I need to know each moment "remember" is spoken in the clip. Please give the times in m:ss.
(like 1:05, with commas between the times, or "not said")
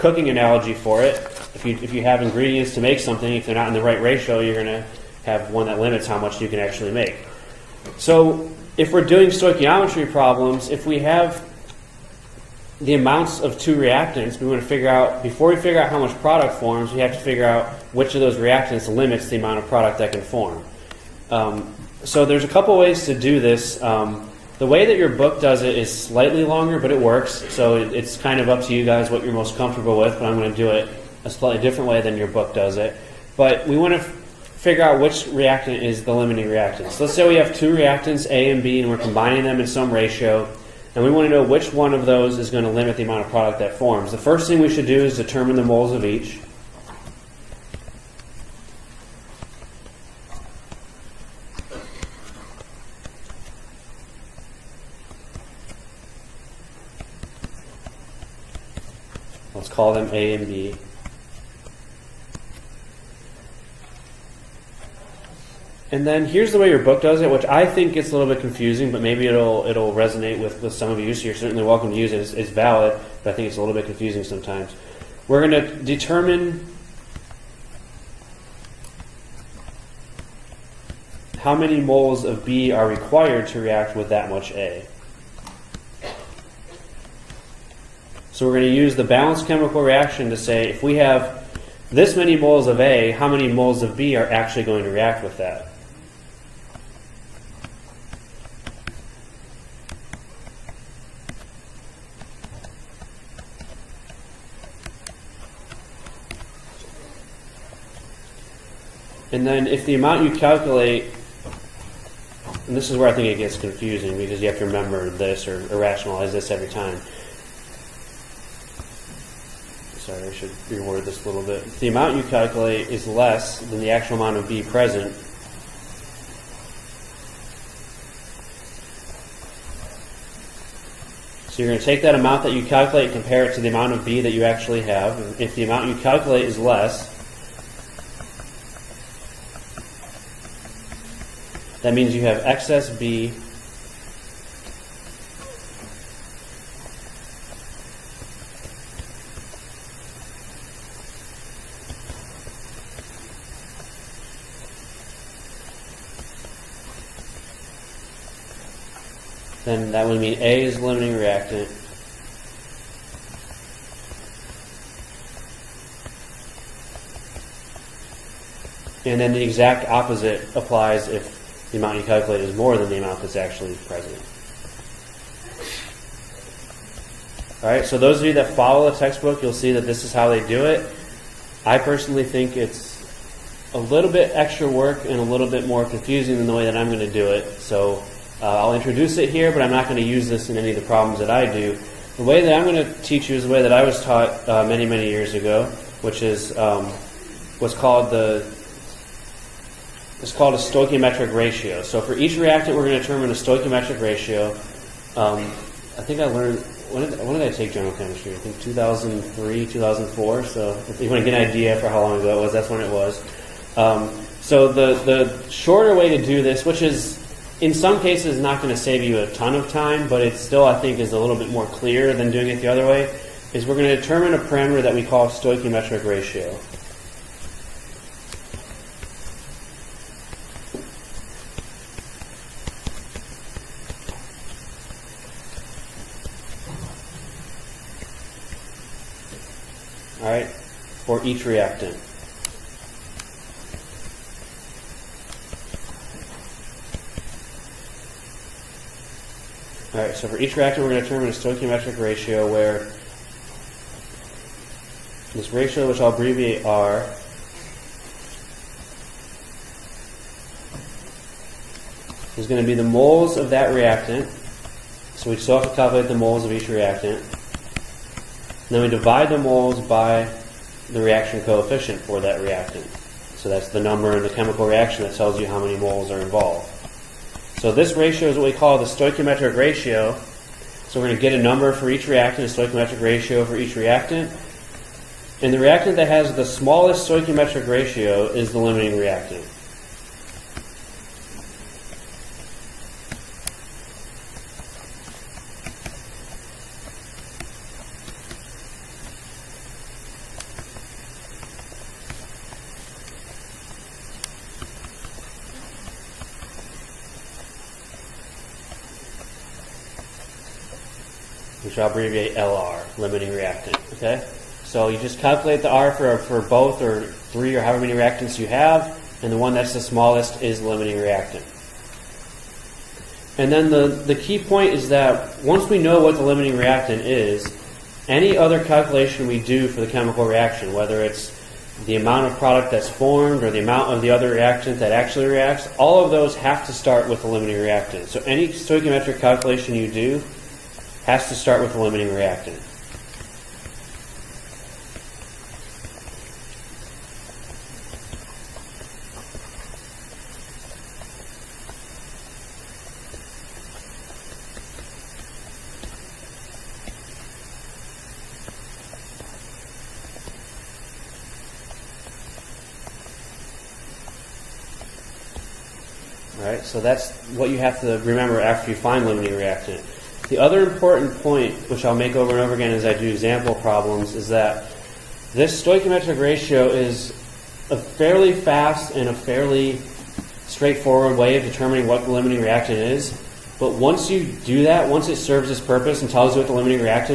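1:54, 6:08.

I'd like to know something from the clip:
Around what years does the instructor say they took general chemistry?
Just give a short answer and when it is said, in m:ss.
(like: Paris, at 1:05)
2003, 2004, at 3:28.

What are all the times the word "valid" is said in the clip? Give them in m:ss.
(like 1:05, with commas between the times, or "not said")
1:12.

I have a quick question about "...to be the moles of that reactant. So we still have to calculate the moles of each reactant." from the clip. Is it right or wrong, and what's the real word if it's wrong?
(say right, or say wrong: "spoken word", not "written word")
right.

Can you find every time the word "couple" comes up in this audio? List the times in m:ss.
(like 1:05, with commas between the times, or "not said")
0:22.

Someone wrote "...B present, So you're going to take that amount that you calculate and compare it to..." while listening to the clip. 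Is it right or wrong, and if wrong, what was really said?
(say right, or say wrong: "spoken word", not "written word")
right.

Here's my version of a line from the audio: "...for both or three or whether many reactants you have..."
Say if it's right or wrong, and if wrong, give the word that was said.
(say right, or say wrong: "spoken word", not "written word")
wrong: "however", not "whether".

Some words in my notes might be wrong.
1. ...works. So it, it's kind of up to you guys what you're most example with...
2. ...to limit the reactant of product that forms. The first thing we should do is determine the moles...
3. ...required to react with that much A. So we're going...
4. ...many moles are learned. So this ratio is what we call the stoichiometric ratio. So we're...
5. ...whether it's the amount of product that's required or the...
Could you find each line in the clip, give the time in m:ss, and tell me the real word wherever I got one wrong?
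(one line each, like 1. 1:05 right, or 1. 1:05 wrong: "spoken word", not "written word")
1. 0:26 wrong: "comfortable", not "example"
2. 0:42 wrong: "amount", not "reactant"
3. 1:22 right
4. 4:35 wrong: "involved", not "learned"
5. 5:30 wrong: "formed", not "required".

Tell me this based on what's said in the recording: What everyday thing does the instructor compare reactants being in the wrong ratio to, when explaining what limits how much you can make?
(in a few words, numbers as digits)
ingredients.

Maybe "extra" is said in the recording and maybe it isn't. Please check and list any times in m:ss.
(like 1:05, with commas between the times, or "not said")
3:04.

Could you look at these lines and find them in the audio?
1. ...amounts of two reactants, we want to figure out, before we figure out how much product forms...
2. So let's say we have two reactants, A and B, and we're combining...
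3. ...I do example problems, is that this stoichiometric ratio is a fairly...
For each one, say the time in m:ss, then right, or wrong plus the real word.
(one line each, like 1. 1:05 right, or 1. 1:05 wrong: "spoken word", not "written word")
1. 0:12 right
2. 0:36 right
3. 6:12 right.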